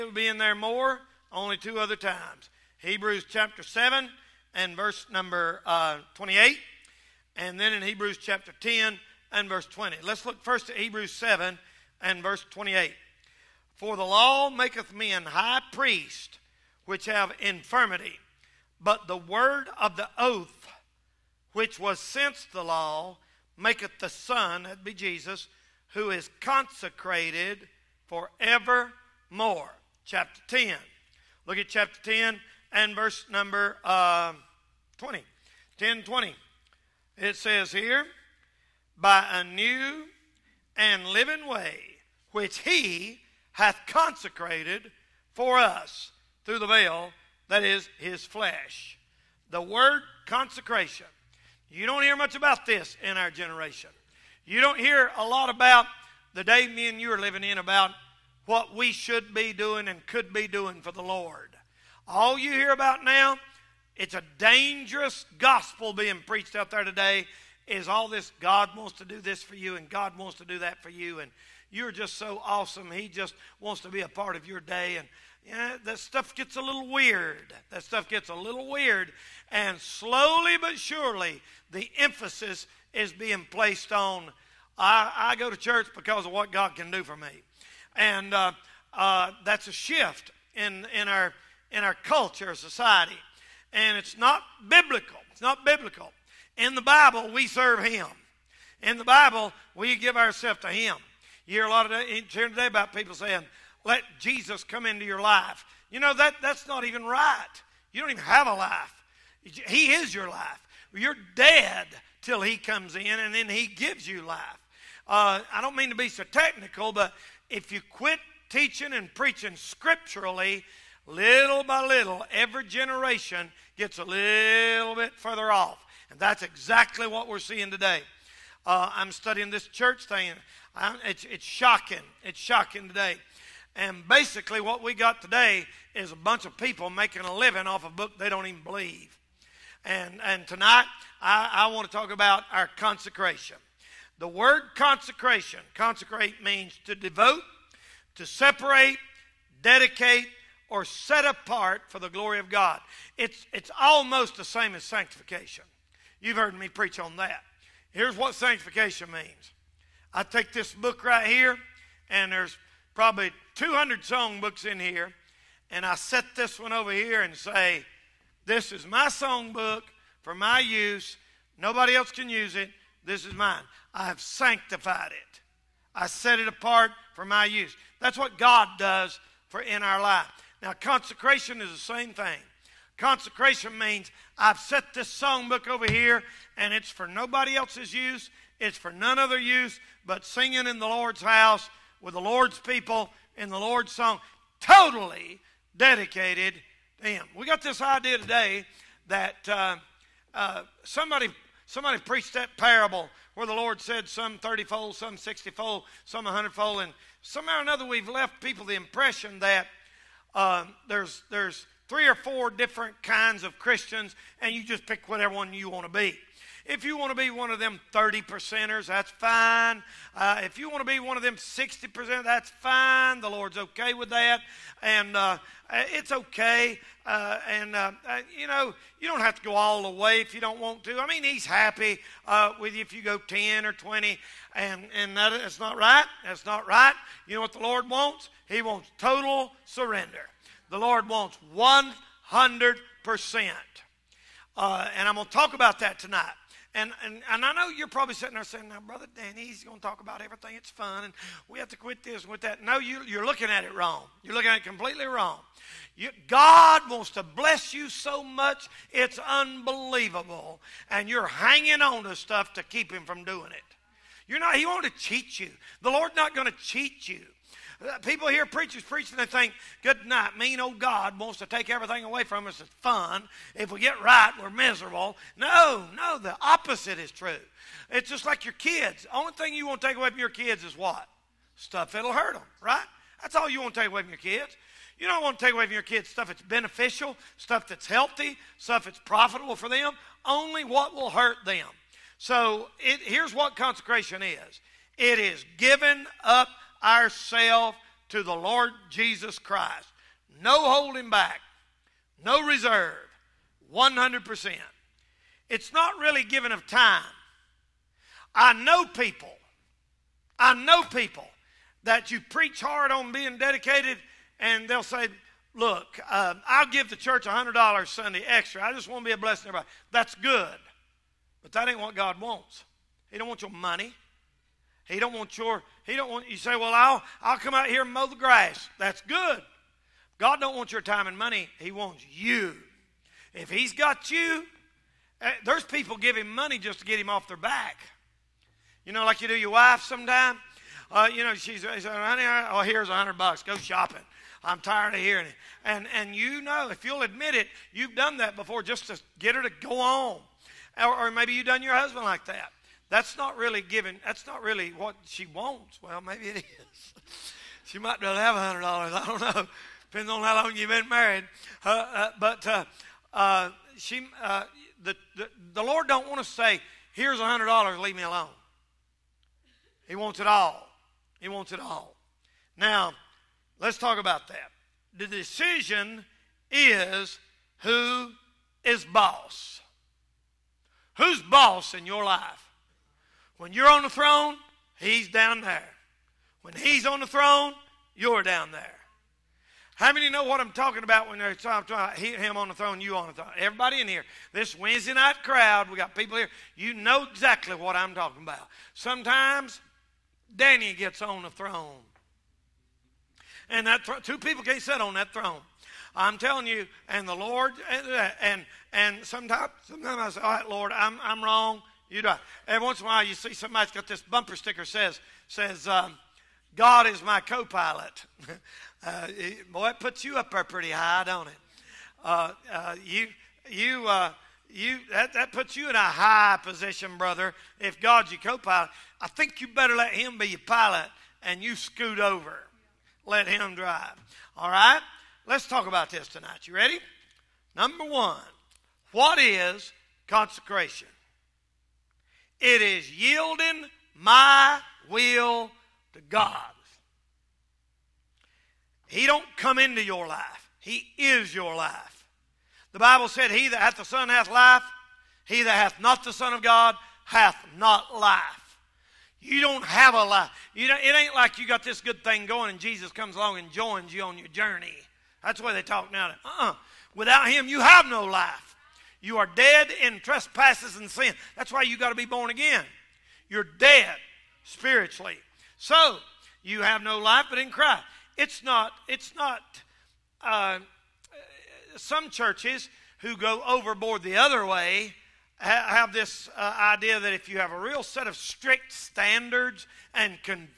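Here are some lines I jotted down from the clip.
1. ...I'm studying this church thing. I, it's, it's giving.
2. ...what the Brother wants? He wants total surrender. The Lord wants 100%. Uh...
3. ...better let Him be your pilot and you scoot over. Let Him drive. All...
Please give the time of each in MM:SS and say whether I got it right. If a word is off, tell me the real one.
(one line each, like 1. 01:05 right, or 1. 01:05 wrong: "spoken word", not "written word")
1. 02:08 wrong: "shocking", not "giving"
2. 03:57 wrong: "Lord", not "Brother"
3. 07:09 right.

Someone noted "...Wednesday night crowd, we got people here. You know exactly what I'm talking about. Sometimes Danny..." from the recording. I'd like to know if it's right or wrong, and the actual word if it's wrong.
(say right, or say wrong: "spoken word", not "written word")
right.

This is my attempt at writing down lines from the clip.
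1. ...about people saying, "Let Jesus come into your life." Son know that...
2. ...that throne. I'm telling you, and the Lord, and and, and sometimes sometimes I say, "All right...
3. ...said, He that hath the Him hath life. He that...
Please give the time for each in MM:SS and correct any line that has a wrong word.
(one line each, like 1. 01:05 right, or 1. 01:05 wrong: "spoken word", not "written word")
1. 01:42 wrong: "You", not "Son"
2. 06:44 right
3. 07:33 wrong: "Son", not "Him".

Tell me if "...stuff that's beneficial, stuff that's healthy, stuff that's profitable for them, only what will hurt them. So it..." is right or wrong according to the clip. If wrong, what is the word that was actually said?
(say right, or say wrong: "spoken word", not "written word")
right.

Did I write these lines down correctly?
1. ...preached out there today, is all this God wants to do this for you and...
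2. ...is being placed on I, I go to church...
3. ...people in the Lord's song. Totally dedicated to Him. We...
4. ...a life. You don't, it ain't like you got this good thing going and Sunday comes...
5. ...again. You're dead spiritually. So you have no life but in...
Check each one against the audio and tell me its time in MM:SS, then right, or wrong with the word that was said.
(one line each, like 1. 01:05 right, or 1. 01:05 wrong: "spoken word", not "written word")
1. 01:06 right
2. 01:22 right
3. 03:12 right
4. 07:39 wrong: "Jesus", not "Sunday"
5. 07:52 right.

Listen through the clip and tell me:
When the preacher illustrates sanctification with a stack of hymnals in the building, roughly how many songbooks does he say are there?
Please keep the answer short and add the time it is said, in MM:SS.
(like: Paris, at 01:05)
200, at 02:43.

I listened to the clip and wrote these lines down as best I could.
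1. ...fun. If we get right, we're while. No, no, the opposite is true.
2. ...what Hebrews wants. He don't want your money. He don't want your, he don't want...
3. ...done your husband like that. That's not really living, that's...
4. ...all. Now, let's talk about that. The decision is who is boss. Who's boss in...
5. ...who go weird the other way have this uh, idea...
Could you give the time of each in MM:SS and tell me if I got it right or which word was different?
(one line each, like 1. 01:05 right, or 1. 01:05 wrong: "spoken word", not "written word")
1. 04:32 wrong: "miserable", not "while"
2. 05:21 wrong: "God", not "Hebrews"
3. 05:51 wrong: "giving", not "living"
4. 06:11 right
5. 08:02 wrong: "overboard", not "weird".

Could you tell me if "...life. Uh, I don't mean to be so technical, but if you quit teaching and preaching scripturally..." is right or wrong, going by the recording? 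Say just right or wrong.
right.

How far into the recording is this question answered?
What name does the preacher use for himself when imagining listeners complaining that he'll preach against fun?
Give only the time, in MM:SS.
04:08.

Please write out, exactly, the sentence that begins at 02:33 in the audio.
It's, it's almost the same as sanctification.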